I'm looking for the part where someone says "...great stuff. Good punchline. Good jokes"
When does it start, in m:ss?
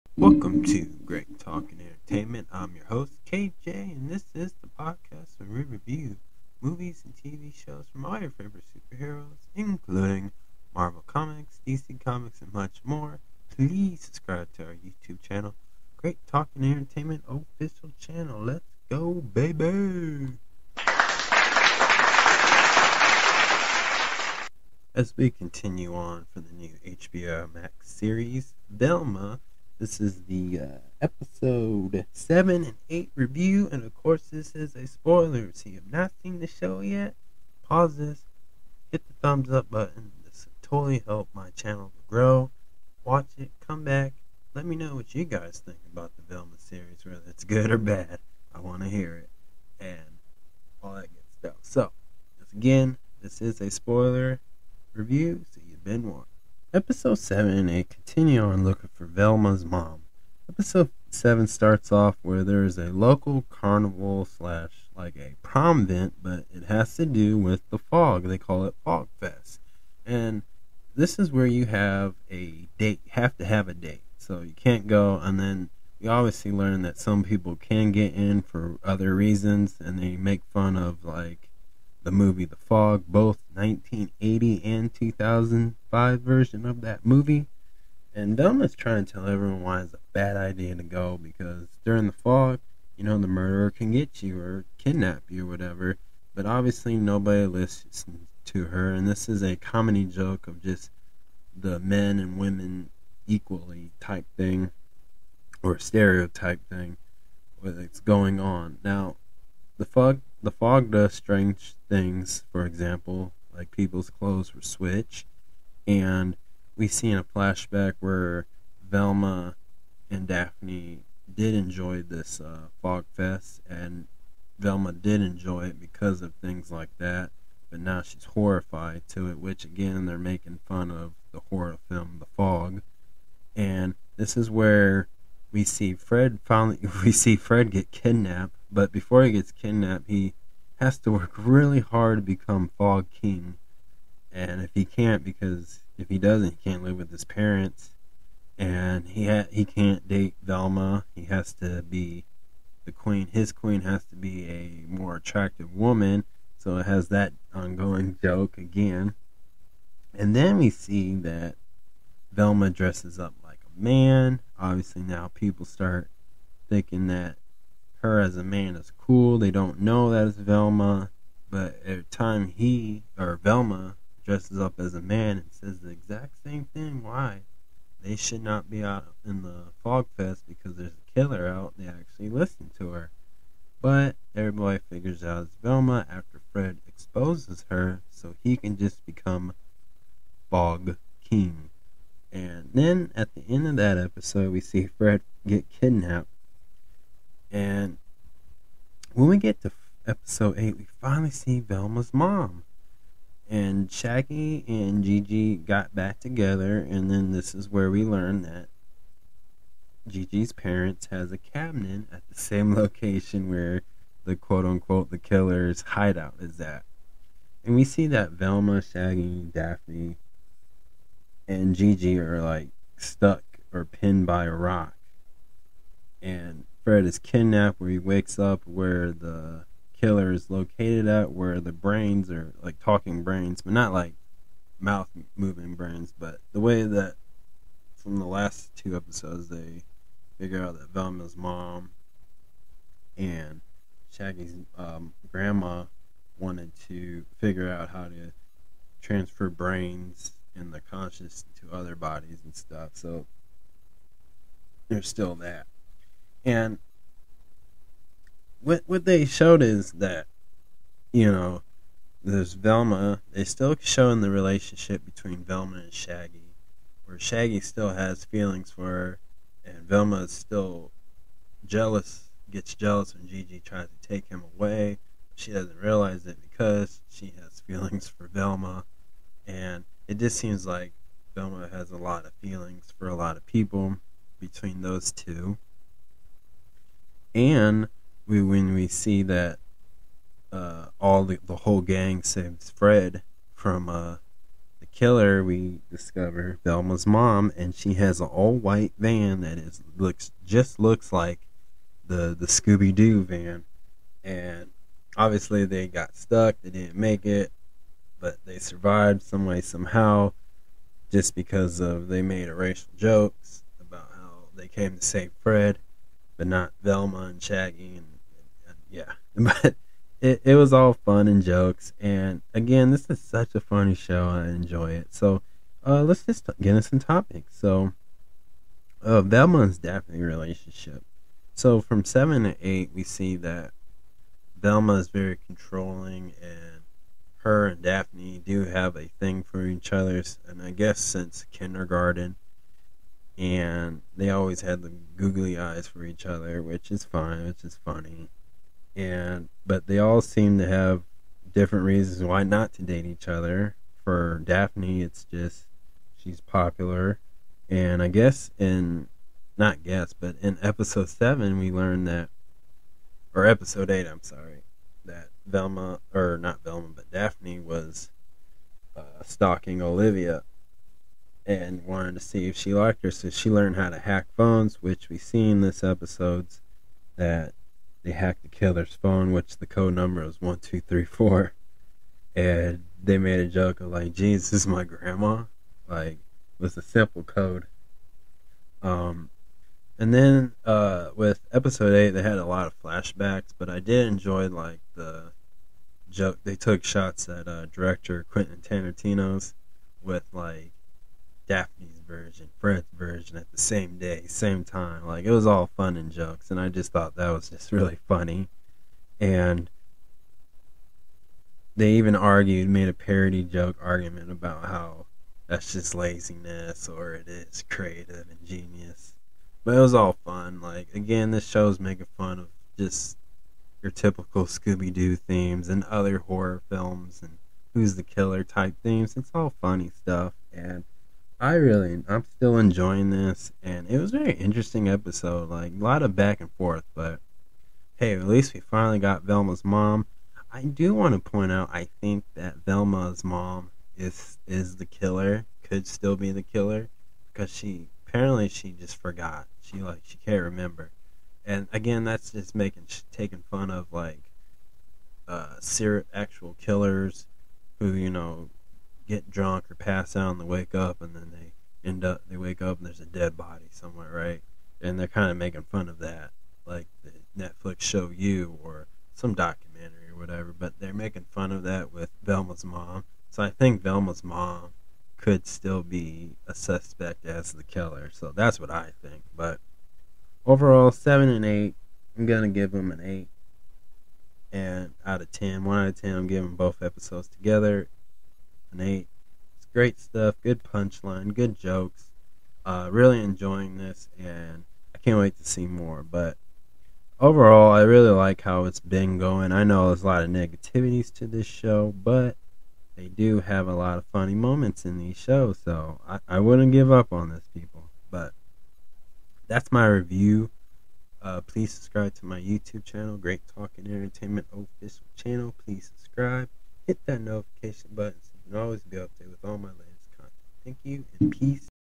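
8:09.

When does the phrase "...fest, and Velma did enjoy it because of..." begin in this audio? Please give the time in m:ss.
2:03.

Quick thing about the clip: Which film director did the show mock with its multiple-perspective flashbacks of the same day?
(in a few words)
Quentin Tarantino.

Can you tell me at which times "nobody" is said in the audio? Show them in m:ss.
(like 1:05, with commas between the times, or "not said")
1:36.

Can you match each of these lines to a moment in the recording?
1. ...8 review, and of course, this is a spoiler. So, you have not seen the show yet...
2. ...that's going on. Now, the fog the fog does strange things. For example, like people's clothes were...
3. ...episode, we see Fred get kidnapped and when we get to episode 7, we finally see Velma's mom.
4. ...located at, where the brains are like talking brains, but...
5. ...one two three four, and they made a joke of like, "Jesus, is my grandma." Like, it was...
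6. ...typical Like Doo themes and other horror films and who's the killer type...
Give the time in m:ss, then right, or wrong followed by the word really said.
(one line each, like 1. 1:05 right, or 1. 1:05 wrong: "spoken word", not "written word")
1. 0:32 right
2. 1:47 right
3. 3:13 wrong: "8", not "7"
4. 3:50 right
5. 6:20 right
6. 7:03 wrong: "Scooby", not "Like".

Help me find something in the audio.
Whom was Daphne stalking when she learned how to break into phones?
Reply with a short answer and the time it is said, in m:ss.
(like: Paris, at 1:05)
Olivia, at 6:09.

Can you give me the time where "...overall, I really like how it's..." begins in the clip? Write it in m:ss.
8:17.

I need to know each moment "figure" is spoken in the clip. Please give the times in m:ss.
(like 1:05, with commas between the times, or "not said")
3:04, 4:00, 4:07.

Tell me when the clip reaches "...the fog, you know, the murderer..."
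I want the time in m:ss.
1:32.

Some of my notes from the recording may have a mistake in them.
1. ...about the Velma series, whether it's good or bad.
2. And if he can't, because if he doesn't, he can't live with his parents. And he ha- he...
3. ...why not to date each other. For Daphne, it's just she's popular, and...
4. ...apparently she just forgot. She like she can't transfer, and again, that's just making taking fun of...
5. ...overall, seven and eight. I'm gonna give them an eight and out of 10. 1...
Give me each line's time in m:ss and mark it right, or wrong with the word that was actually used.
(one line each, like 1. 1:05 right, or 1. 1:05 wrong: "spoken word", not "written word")
1. 0:45 right
2. 2:24 right
3. 5:52 right
4. 7:28 wrong: "remember", not "transfer"
5. 8:00 right.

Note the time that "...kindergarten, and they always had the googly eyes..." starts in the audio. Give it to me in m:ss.
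5:41.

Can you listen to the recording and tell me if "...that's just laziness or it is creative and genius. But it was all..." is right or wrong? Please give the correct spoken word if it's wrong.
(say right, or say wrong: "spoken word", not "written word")
right.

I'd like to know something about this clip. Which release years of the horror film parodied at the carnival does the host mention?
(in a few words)
1980 and 2005.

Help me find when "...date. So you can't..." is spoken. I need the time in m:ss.
1:13.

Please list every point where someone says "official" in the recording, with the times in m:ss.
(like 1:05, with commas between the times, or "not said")
0:17, 8:34.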